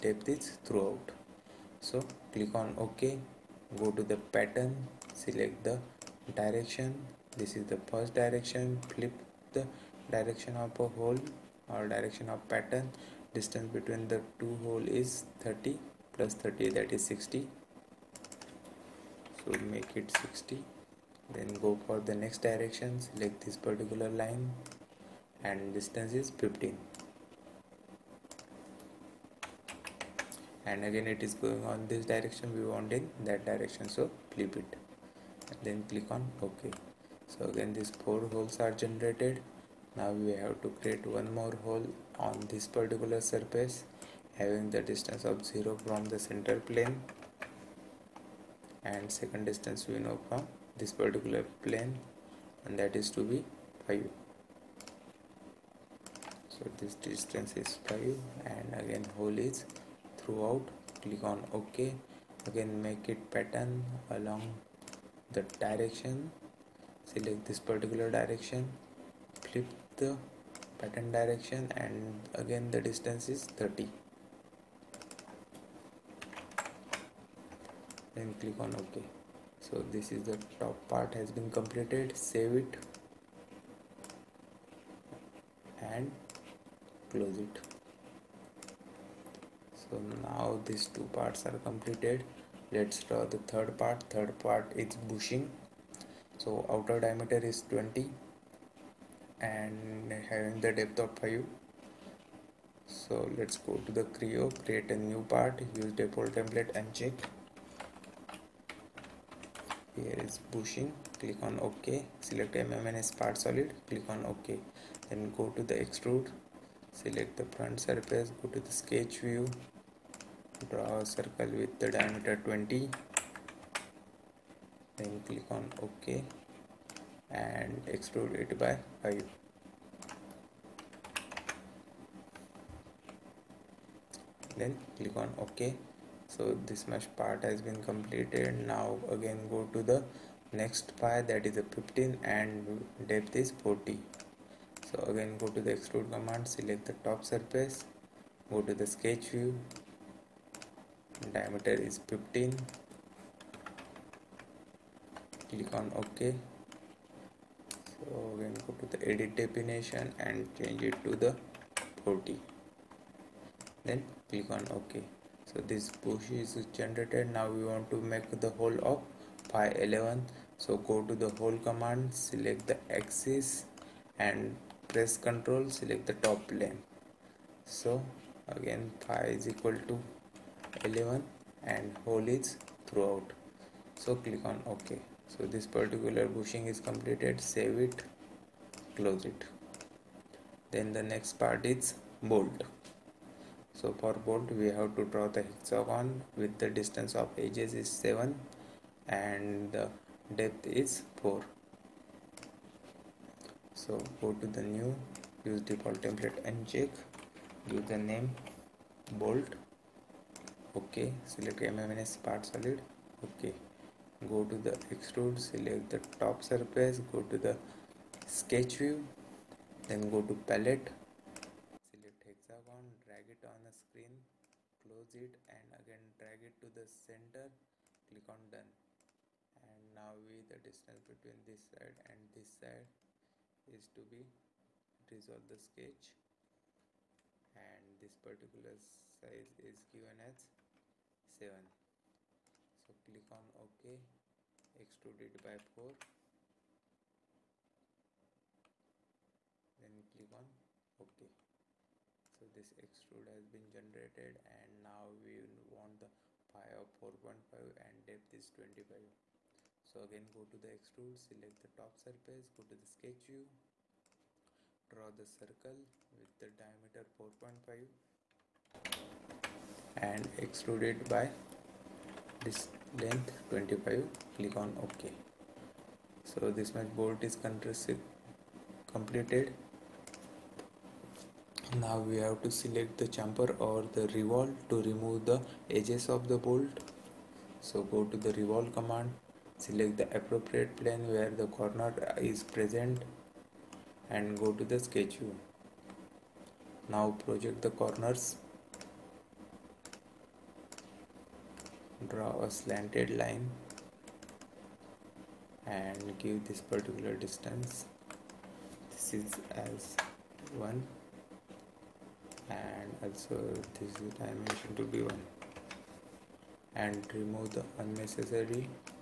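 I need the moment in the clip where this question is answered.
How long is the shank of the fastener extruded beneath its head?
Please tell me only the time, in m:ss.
4:33.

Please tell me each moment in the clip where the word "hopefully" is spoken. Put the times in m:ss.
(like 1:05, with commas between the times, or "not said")
not said.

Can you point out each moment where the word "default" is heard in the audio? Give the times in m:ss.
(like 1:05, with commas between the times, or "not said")
1:46, 3:25.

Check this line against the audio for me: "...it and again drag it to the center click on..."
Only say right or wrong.
right.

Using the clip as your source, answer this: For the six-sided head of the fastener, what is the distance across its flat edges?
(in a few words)
7.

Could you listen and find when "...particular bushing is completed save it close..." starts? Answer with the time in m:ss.
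3:05.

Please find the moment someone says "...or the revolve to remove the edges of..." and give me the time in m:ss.
4:43.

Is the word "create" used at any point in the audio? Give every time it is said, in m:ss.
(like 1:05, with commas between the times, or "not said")
0:40, 1:44.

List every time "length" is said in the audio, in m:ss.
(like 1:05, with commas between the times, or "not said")
4:33.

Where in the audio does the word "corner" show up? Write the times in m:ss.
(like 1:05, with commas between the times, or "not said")
4:51, 4:57.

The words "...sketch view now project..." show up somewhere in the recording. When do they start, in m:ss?
4:54.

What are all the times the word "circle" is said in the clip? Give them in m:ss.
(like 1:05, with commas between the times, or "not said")
2:01, 4:25.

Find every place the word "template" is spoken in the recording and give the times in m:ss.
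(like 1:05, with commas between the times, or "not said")
1:46, 3:26.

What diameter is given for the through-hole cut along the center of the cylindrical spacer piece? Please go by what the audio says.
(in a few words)
11.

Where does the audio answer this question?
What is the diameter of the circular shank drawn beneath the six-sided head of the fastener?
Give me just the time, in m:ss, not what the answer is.
4:26.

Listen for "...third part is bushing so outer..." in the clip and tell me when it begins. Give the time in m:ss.
1:34.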